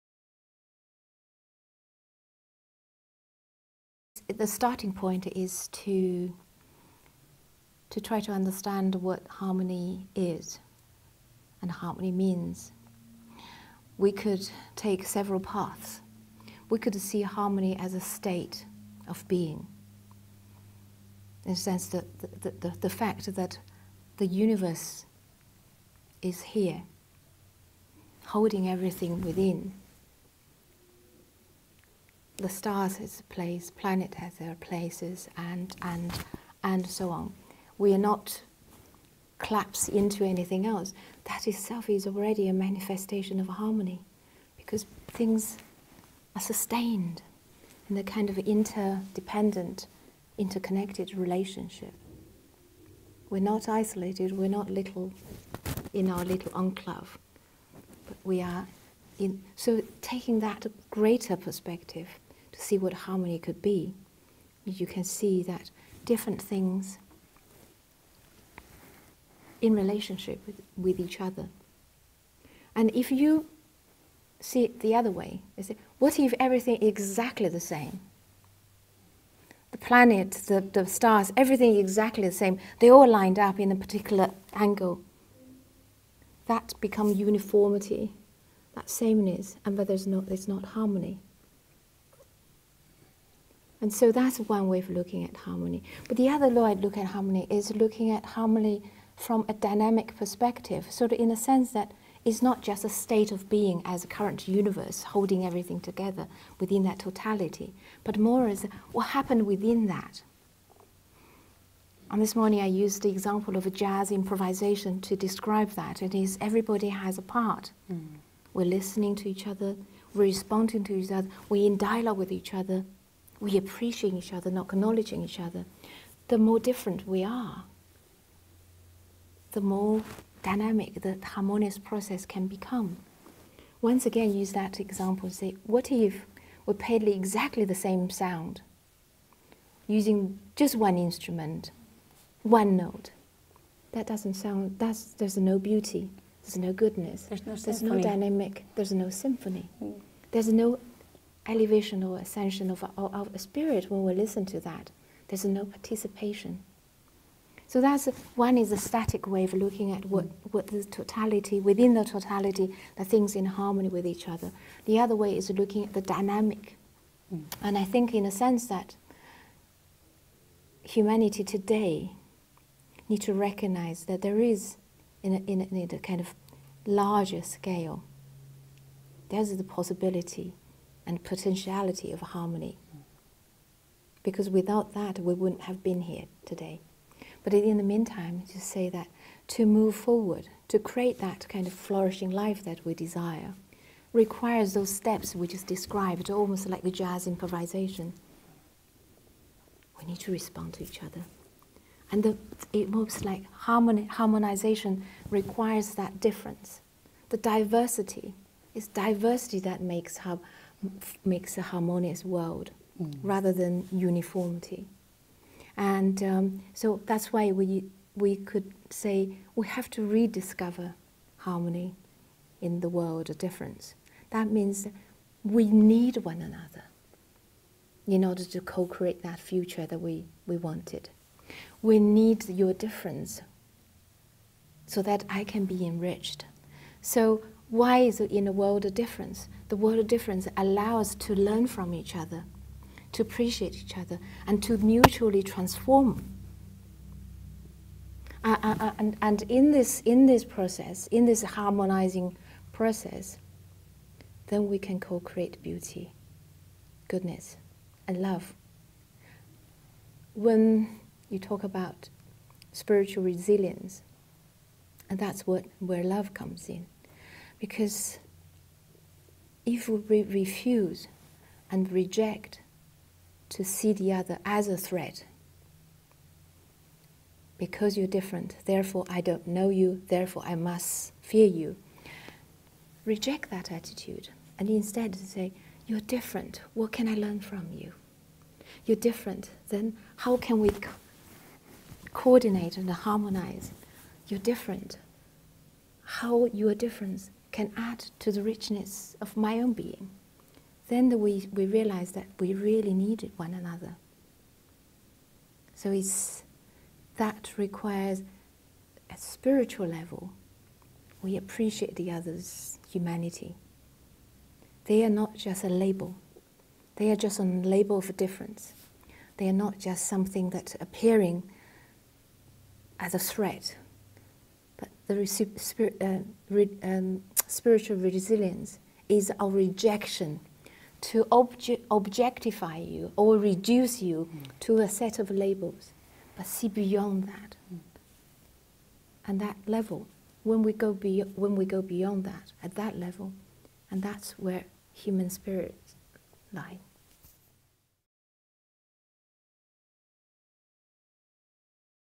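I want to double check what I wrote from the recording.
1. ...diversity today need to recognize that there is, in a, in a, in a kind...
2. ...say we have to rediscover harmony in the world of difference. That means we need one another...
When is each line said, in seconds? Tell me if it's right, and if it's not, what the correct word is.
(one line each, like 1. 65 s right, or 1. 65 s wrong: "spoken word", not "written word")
1. 170 s wrong: "humanity", not "diversity"
2. 218 s right.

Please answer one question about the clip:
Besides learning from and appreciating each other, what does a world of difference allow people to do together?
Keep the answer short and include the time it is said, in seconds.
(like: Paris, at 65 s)
Mutually transform, at 244 s.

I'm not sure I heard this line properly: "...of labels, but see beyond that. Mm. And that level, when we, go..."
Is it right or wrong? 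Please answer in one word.
right.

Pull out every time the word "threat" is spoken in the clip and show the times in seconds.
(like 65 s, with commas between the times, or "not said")
274 s, 323 s.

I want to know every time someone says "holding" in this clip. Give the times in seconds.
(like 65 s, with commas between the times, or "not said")
28 s, 105 s.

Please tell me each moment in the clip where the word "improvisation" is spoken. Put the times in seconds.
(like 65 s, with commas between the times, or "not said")
114 s, 197 s.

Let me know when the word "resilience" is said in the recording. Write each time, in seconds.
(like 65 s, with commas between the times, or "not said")
263 s, 327 s.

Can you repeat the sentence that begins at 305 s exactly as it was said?
So it's, that requires a spiritual level.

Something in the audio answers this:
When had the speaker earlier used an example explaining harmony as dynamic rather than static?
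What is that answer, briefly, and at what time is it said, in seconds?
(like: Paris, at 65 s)
This morning, at 112 s.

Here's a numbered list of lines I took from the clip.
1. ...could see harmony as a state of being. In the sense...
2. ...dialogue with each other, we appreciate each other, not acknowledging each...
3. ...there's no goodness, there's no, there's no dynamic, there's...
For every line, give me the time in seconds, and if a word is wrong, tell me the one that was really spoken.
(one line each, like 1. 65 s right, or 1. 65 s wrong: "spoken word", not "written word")
1. 16 s right
2. 121 s right
3. 146 s right.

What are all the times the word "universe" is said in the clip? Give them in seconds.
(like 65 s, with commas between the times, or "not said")
24 s, 104 s.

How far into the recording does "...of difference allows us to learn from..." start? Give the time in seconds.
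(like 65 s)
239 s.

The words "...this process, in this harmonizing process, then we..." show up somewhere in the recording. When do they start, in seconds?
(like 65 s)
250 s.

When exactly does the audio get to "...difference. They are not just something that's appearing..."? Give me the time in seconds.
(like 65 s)
318 s.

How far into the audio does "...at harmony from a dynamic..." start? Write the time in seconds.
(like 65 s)
98 s.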